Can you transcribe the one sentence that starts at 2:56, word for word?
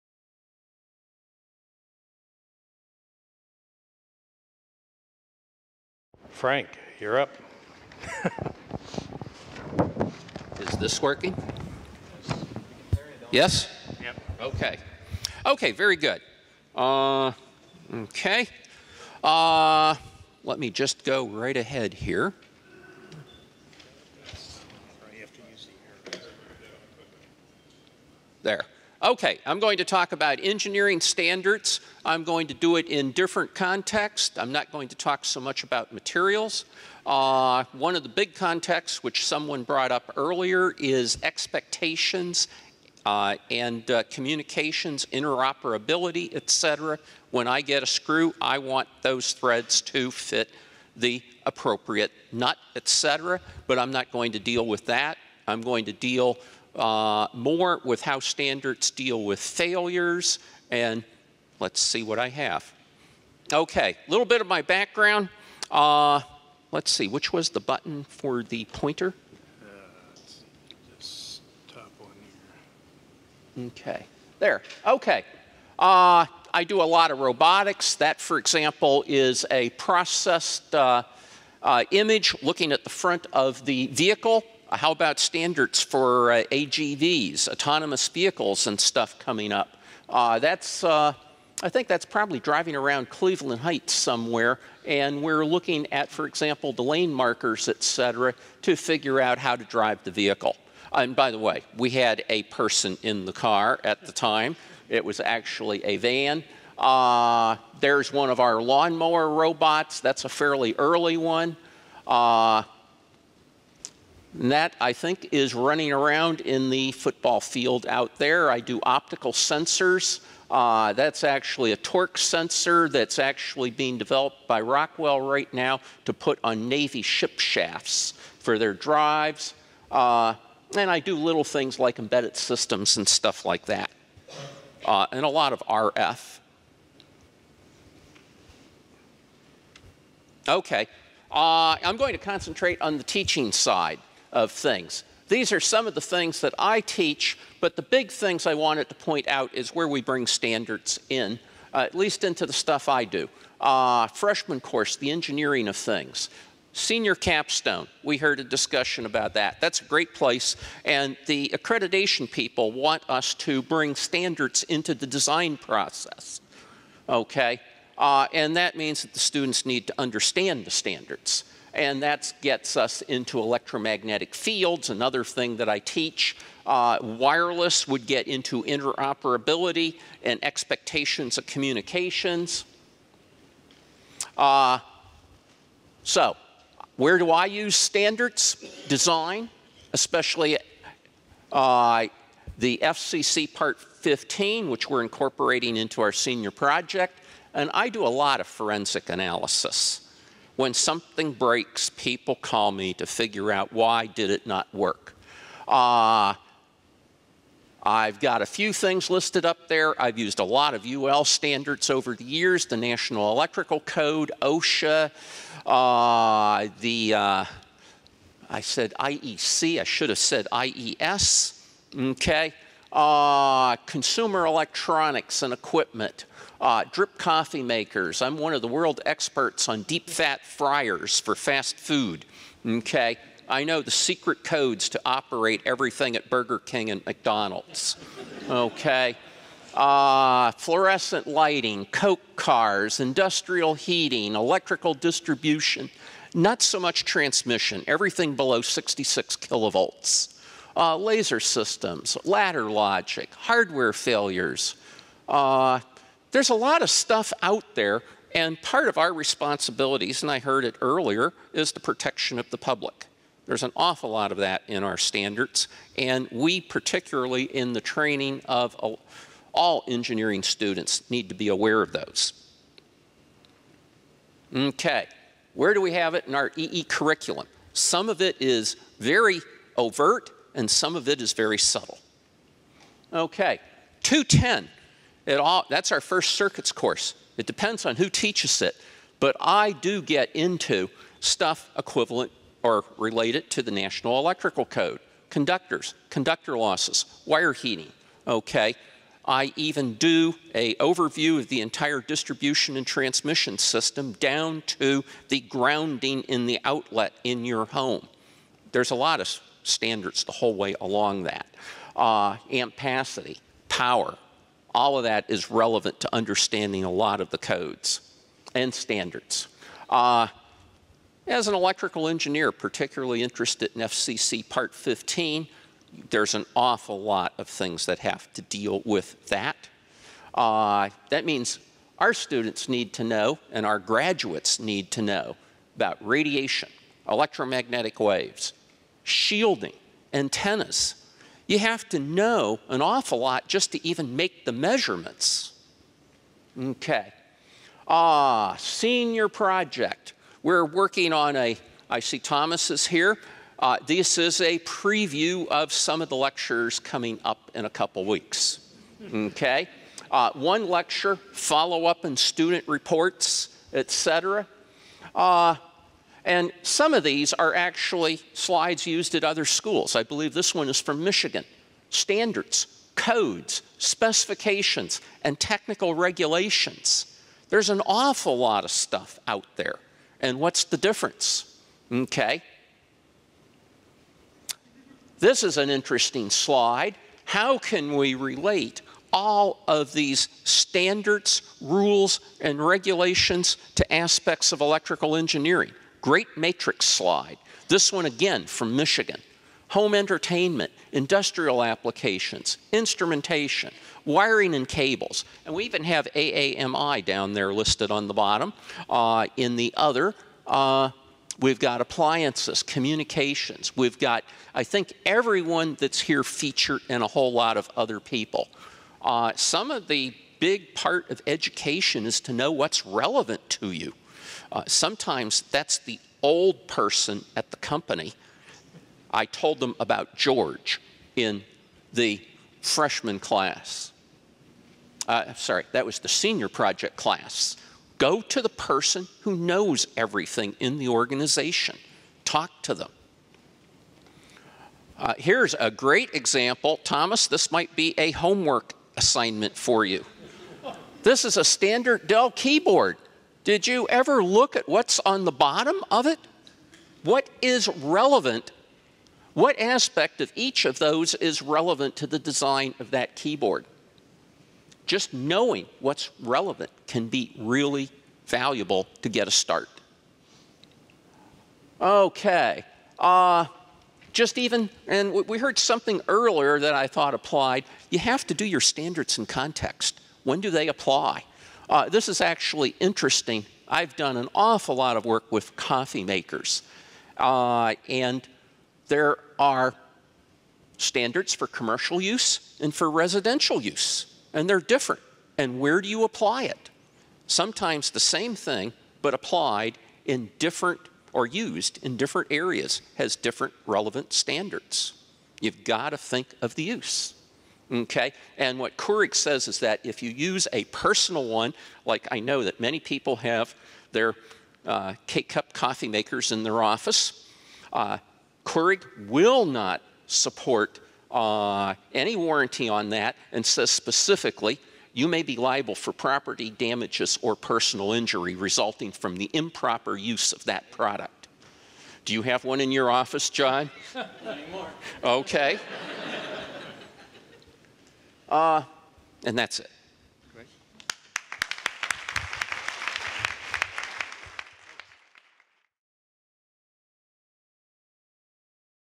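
Uh, wireless would get into interoperability and expectations of communications.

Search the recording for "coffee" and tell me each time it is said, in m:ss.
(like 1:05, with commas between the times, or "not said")
3:47, 8:05, 8:35.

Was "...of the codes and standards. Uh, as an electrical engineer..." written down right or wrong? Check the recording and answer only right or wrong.
right.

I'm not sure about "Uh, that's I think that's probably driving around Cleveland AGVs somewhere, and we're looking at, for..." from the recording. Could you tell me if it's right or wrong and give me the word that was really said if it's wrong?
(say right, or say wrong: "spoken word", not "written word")
wrong: "Heights", not "AGVs".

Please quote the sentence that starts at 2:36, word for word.
Senior capstone, we heard a discussion about that.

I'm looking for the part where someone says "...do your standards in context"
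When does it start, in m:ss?
7:58.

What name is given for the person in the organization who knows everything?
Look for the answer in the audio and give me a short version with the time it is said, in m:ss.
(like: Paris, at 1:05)
George, at 7:10.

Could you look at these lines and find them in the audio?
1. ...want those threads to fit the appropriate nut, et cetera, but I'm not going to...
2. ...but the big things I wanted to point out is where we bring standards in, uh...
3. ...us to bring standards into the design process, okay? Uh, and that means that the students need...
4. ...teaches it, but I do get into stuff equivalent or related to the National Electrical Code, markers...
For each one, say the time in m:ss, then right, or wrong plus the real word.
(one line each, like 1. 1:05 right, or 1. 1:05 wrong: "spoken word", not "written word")
1. 0:48 right
2. 2:27 right
3. 2:43 right
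4. 4:48 wrong: "conductors", not "markers".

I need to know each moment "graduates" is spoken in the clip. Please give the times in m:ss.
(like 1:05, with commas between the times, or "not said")
5:33.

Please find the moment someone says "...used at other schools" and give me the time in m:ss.
6:08.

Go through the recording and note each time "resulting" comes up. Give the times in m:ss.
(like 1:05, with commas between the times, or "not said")
8:48.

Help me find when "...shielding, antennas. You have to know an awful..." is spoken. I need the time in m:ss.
5:39.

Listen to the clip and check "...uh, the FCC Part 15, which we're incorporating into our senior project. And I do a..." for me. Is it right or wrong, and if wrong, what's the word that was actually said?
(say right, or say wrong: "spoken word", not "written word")
right.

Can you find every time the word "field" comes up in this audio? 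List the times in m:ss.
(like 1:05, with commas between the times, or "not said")
1:57, 2:54.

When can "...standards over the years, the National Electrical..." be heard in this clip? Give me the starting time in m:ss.
3:31.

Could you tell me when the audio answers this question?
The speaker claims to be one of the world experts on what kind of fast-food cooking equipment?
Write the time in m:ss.
3:49.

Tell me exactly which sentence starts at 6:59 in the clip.
Uh, some of the big part of education is to know what's relevant to you.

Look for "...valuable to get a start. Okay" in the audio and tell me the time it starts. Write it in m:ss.
7:48.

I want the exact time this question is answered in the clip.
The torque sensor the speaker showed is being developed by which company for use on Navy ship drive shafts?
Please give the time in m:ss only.
2:04.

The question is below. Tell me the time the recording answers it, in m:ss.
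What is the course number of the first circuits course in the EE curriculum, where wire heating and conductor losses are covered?
4:44.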